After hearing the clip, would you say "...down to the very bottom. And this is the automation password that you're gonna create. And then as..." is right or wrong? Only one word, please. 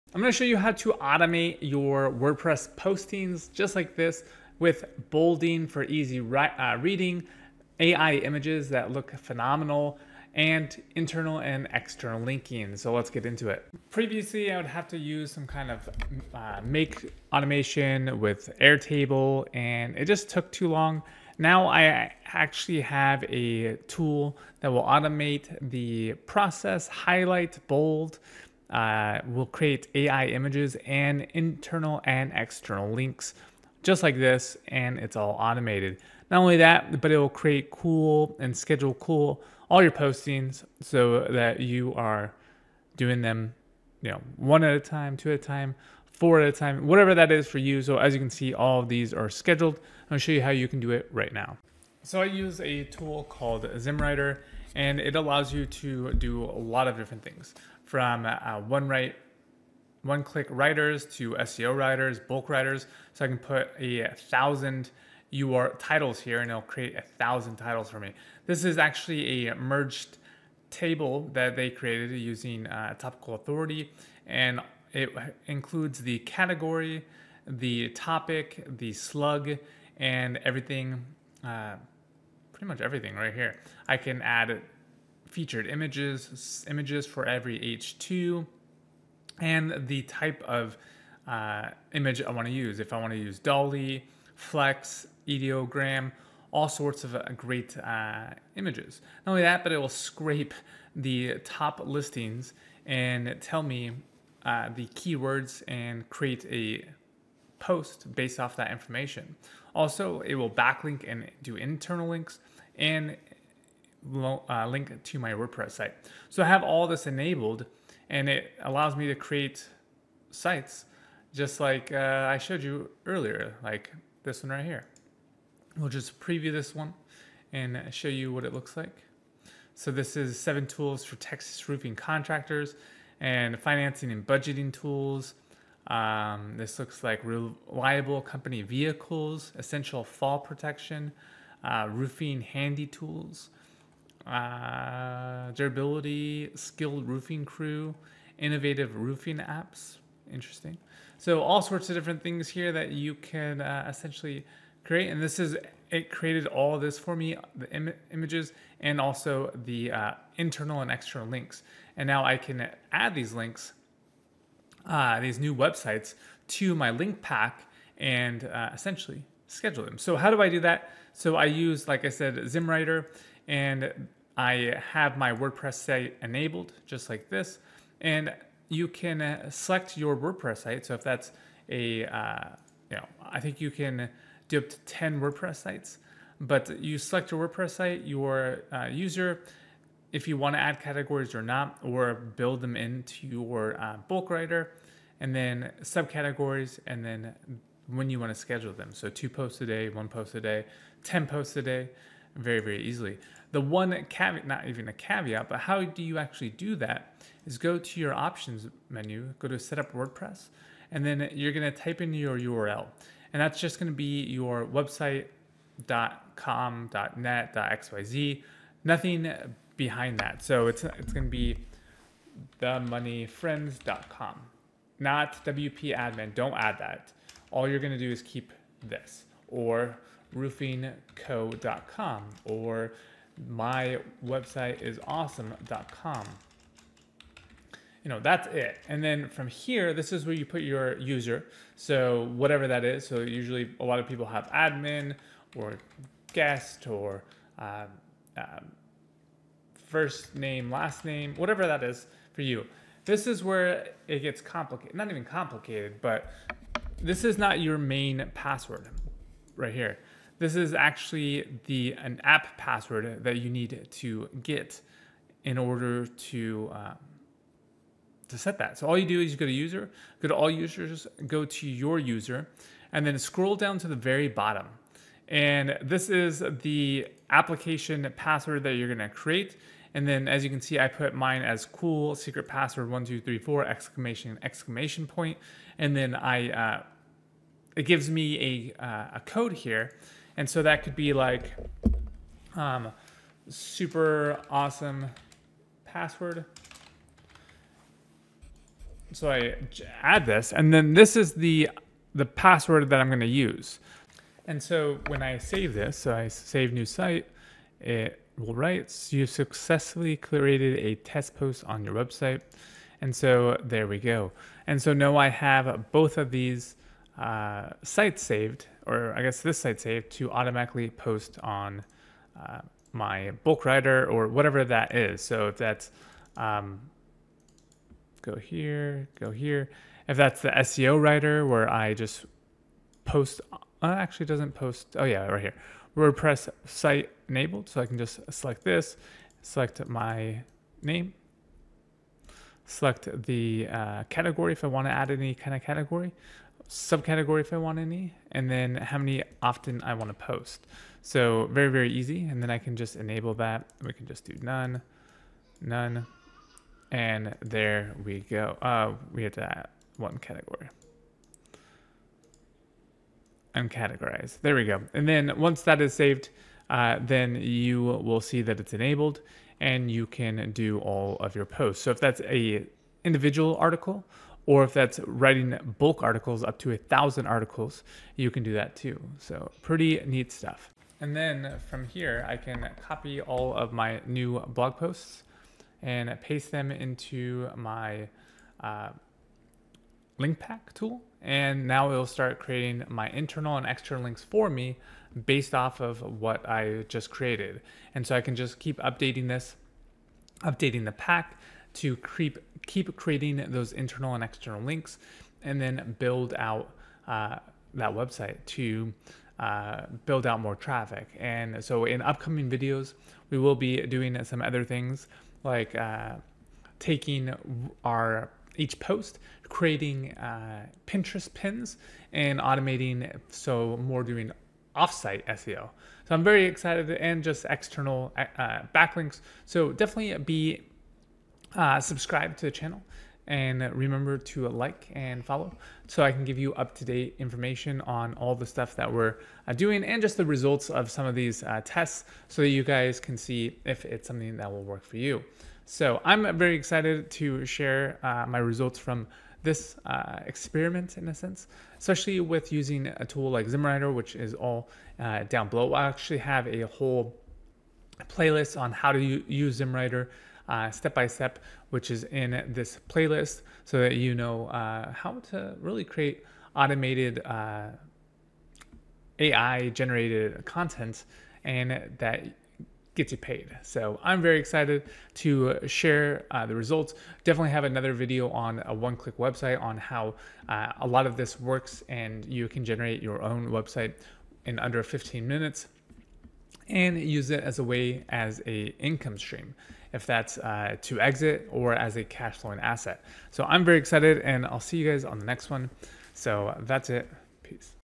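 wrong.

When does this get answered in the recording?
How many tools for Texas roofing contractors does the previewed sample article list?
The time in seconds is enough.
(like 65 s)
130 s.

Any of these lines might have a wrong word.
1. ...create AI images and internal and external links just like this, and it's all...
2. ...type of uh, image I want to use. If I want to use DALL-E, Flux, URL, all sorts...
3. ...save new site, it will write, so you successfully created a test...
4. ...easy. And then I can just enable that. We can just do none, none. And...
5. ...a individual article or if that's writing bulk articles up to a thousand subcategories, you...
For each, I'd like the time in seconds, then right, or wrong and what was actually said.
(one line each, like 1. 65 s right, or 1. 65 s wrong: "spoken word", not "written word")
1. 29 s right
2. 90 s wrong: "Ideogram", not "URL"
3. 306 s right
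4. 351 s right
5. 372 s wrong: "articles", not "subcategories".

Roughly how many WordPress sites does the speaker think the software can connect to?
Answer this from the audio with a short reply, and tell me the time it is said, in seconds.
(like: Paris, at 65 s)
10, at 184 s.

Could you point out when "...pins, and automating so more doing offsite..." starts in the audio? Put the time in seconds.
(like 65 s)
421 s.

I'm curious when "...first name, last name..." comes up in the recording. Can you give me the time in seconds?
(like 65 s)
249 s.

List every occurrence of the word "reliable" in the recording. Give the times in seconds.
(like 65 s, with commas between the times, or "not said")
137 s.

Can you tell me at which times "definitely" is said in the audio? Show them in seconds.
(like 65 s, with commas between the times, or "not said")
429 s, 477 s.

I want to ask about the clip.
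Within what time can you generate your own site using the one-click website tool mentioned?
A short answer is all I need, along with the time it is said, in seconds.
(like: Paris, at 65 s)
under 15 minutes, at 484 s.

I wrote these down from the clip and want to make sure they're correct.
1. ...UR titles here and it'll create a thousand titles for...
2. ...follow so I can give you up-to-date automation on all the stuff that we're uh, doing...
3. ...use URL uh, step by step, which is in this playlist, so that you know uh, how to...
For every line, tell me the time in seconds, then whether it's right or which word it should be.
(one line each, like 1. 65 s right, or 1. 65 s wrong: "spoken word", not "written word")
1. 65 s right
2. 435 s wrong: "information", not "automation"
3. 458 s wrong: "Zimmwriter", not "URL".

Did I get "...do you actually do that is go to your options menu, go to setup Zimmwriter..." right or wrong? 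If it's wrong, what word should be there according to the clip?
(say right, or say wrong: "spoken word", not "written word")
wrong: "WordPress", not "Zimmwriter".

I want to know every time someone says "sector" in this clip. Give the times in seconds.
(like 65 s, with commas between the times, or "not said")
not said.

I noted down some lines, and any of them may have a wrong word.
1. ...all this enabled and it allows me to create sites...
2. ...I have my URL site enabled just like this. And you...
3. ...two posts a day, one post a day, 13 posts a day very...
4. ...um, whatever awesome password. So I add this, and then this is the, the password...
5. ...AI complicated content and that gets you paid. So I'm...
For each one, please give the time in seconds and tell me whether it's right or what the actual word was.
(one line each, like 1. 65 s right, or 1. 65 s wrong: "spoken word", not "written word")
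1. 116 s right
2. 174 s wrong: "WordPress", not "URL"
3. 199 s wrong: "10", not "13"
4. 292 s wrong: "super", not "whatever"
5. 469 s wrong: "generated", not "complicated".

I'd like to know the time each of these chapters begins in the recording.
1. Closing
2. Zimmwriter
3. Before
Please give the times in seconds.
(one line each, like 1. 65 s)
1. 480 s
2. 90 s
3. 30 s.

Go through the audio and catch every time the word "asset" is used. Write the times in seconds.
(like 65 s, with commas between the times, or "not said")
492 s.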